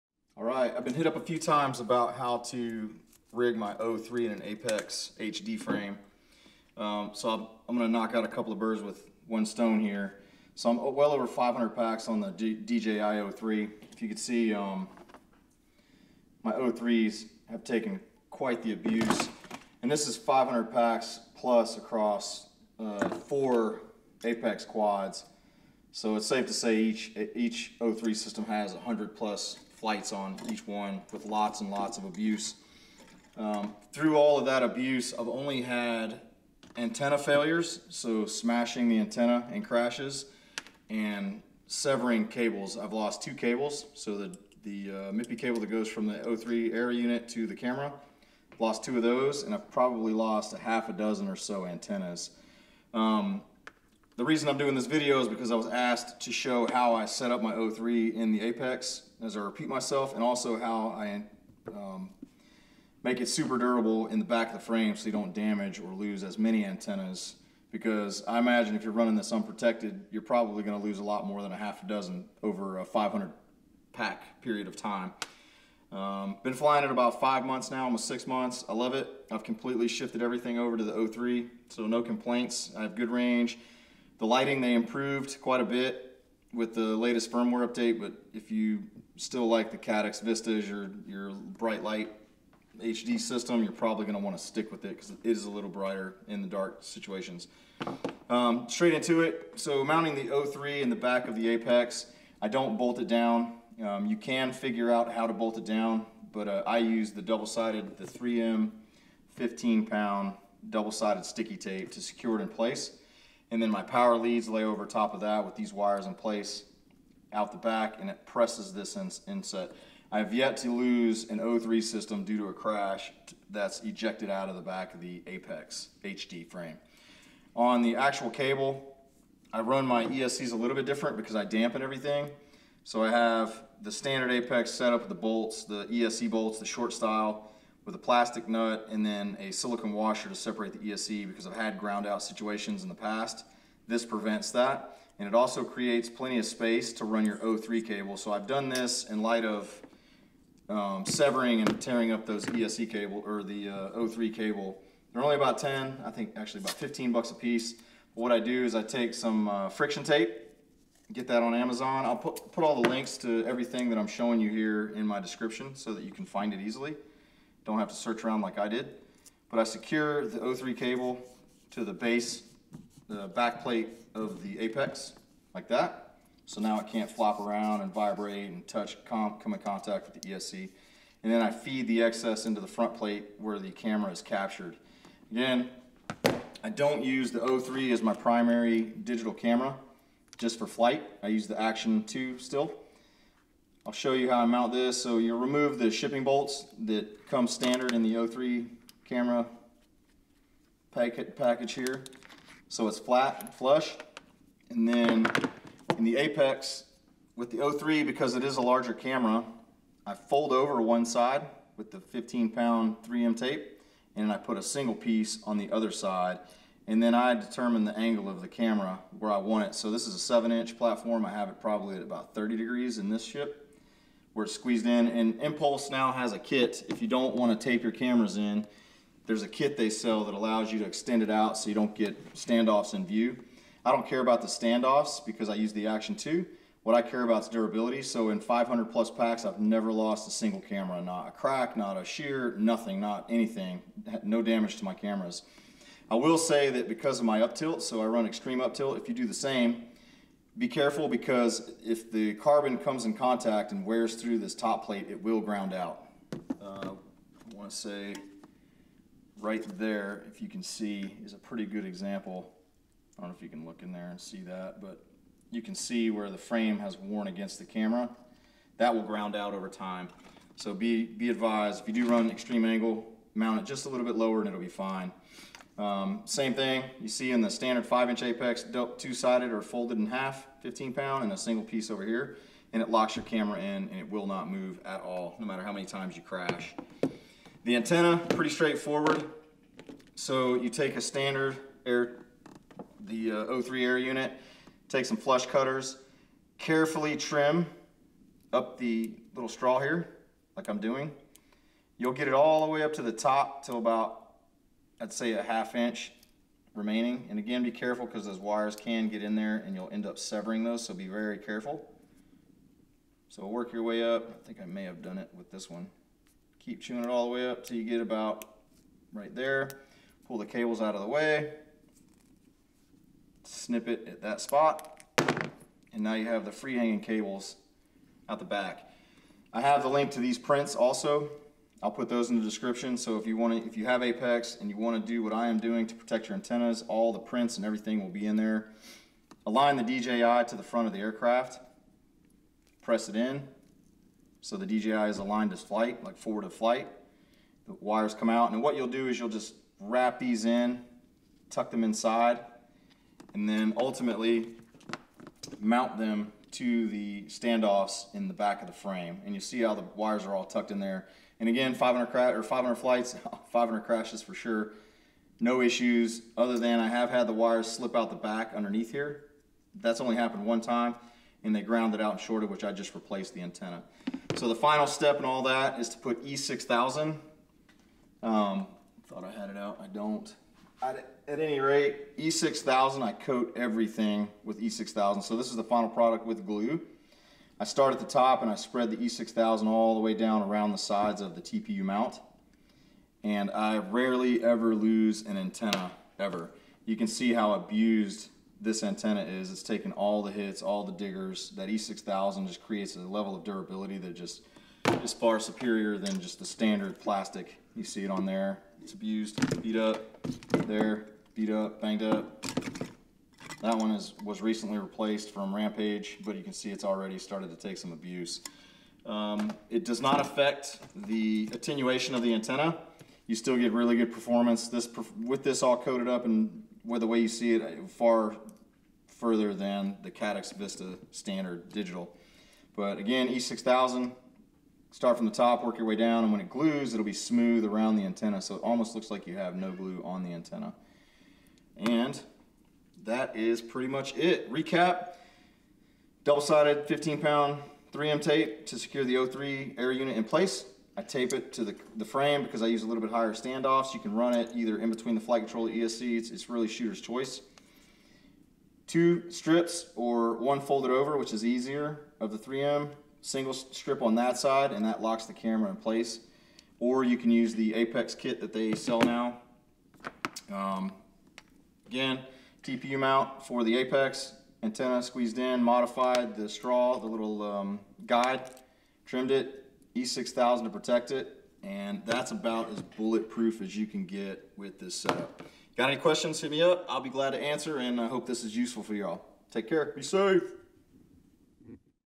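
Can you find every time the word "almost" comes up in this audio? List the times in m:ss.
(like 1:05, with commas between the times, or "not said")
1:17, 7:18.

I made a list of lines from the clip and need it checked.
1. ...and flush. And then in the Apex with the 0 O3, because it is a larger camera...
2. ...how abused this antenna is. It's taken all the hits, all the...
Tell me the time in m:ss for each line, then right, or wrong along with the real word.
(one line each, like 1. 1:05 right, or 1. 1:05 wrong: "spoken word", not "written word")
1. 3:23 right
2. 6:37 right.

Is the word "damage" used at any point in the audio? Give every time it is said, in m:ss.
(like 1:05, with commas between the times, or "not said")
1:05, 4:04.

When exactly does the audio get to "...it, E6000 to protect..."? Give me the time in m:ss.
7:59.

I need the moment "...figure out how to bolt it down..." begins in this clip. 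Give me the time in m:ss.
1:44.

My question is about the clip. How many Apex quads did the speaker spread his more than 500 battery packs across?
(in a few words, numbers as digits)
4.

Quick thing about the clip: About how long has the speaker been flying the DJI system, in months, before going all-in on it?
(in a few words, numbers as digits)
5 months.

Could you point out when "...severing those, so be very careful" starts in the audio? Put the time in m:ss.
5:10.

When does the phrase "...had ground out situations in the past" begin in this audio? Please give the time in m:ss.
2:21.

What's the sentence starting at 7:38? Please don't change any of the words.
Two strips or one folded over, which is easier, of the 3M.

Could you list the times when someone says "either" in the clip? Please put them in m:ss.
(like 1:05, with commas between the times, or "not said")
7:34.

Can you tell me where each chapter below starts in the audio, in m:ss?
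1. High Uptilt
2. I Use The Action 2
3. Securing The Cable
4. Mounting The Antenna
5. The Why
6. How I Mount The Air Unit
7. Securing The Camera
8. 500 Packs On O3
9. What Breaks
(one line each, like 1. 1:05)
1. 4:05
2. 3:06
3. 2:07
4. 4:48
5. 0:52
6. 1:39
7. 3:25
8. 0:11
9. 0:35.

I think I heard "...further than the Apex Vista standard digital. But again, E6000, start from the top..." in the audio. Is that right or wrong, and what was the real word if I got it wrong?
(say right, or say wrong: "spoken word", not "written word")
wrong: "Caddx", not "Apex".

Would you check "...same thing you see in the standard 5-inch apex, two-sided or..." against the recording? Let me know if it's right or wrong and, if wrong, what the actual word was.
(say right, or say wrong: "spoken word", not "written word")
right.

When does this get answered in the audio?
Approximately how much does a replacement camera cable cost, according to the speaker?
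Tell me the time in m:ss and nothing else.
2:36.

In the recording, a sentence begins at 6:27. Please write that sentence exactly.
I start at the top and I spread the E6000 all the way down around the sides of the TPU mount.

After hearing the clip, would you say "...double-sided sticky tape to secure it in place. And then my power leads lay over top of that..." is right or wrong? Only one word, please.
right.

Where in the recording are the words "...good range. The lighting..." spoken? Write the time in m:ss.
1:22.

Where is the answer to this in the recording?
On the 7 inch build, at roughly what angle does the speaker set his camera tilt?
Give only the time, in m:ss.
3:42.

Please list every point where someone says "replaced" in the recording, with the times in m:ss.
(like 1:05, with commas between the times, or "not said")
6:12, 6:54.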